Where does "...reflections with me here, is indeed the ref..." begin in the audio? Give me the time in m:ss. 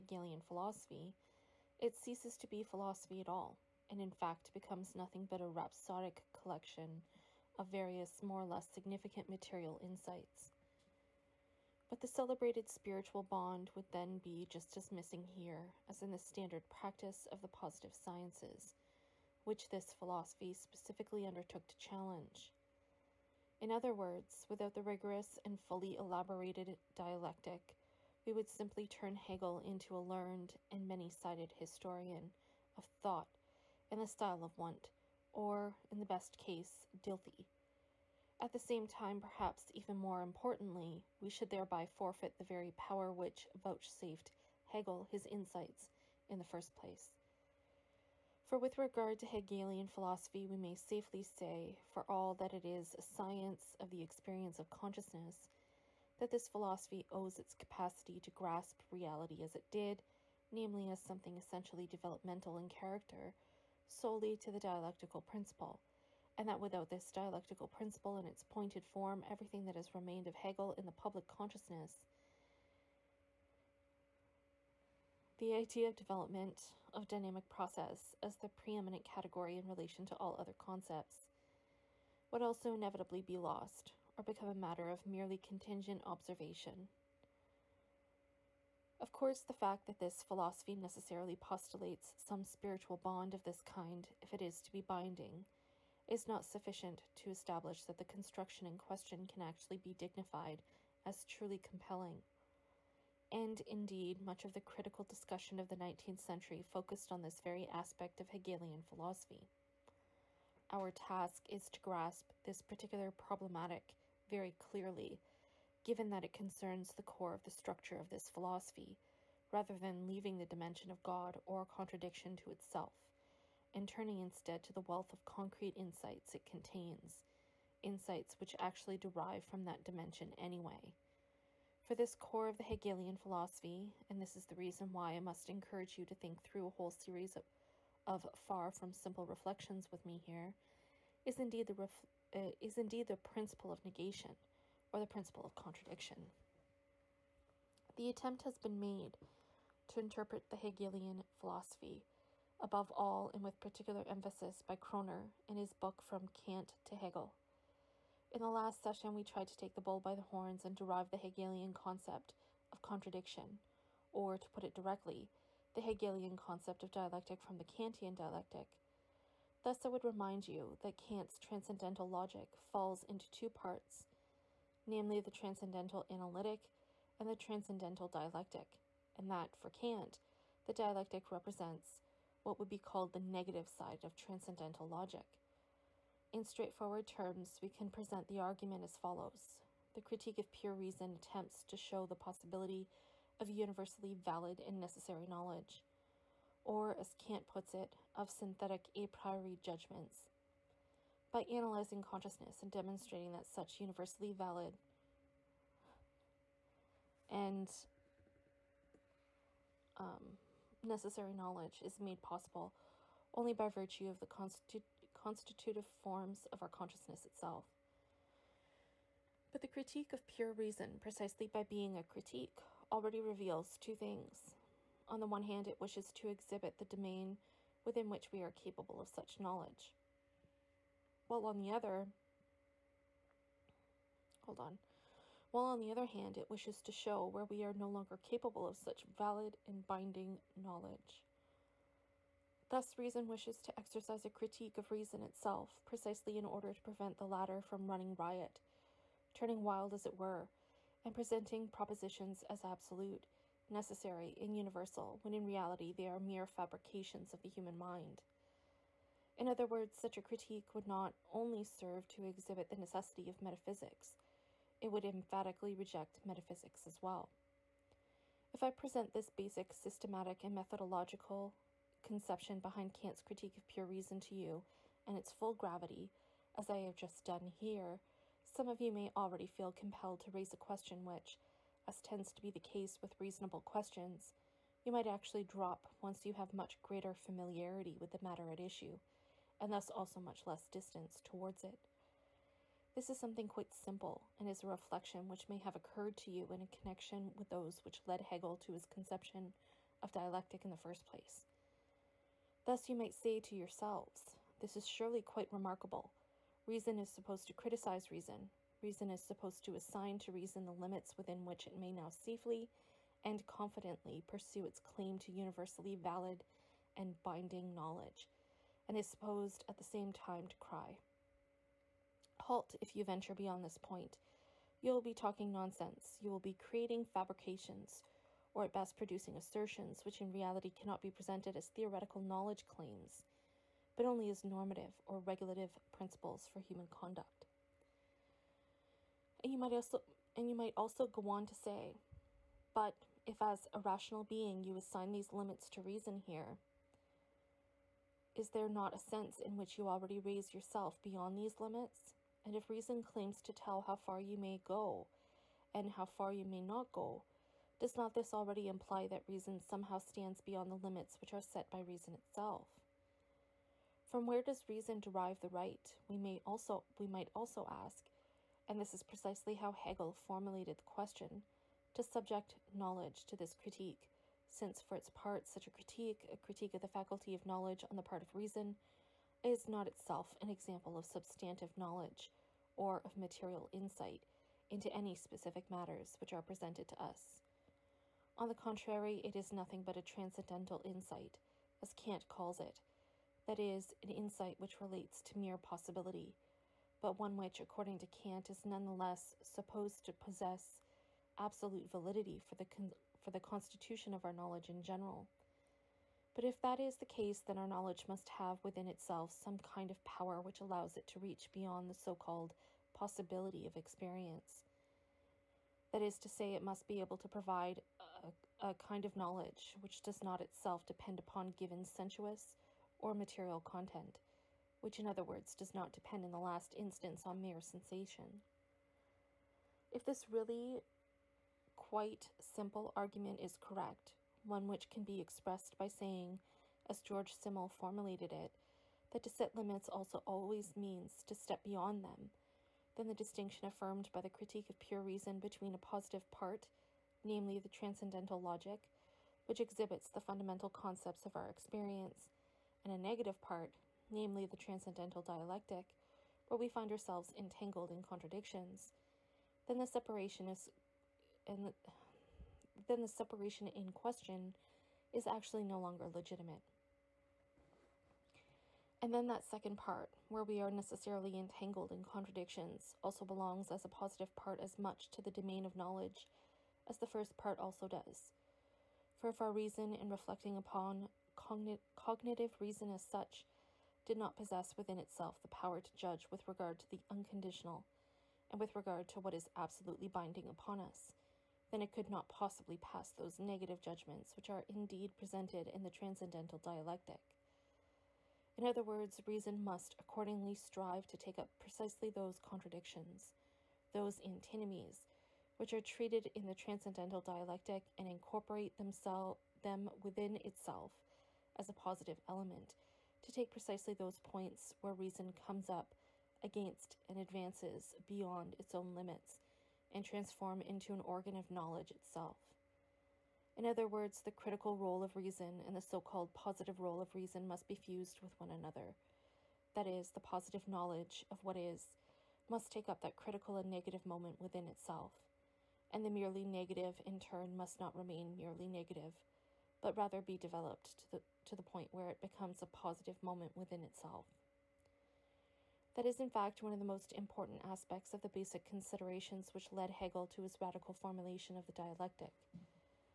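2:19.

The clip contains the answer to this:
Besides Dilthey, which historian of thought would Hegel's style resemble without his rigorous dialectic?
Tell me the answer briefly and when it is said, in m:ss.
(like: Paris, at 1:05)
Wundt, at 0:34.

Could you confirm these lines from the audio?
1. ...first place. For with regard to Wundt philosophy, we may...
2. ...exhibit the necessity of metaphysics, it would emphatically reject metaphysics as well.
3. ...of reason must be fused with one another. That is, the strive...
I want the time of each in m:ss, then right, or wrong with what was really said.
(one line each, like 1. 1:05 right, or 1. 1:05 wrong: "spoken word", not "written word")
1. 0:46 wrong: "Hegelian", not "Wundt"
2. 4:22 right
3. 8:46 wrong: "positive", not "strive".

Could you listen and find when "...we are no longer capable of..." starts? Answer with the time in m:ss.
3:57.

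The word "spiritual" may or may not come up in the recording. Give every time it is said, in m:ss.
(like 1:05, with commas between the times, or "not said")
0:12, 1:32.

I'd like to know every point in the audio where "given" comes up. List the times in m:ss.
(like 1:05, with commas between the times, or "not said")
1:55, 7:01.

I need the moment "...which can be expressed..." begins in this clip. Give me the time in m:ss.
7:14.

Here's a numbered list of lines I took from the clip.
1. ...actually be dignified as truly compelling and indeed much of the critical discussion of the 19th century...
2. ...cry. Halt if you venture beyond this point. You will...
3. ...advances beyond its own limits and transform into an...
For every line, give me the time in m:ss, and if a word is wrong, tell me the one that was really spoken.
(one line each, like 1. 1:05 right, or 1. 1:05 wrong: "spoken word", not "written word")
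1. 1:39 right
2. 5:20 right
3. 8:37 right.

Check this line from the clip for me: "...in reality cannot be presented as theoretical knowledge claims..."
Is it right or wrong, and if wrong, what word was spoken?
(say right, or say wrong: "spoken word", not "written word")
right.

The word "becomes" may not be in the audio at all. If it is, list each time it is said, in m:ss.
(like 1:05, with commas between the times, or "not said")
0:04, 1:24, 9:02.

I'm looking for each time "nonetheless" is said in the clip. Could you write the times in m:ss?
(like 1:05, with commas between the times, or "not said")
6:38.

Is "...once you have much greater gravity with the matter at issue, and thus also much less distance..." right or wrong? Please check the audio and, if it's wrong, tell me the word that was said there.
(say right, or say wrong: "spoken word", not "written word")
wrong: "familiarity", not "gravity".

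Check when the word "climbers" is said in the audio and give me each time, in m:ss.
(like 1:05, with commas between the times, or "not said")
not said.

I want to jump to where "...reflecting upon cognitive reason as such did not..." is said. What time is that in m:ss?
8:00.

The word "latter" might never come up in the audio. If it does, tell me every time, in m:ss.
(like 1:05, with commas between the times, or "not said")
4:07.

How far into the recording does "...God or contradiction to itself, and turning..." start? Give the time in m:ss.
2:01.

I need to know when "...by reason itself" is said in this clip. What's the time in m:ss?
6:01.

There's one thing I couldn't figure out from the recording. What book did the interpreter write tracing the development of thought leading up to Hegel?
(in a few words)
From Kant to Hegel.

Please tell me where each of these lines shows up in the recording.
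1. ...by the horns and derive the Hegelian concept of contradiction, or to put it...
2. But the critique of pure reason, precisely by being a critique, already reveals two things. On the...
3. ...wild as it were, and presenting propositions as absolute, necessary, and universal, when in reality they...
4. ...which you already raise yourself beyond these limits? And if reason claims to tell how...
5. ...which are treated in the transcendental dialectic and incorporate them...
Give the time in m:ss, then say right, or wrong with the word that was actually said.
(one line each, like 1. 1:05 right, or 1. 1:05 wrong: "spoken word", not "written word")
1. 2:39 right
2. 3:39 right
3. 4:09 right
4. 5:49 right
5. 8:25 right.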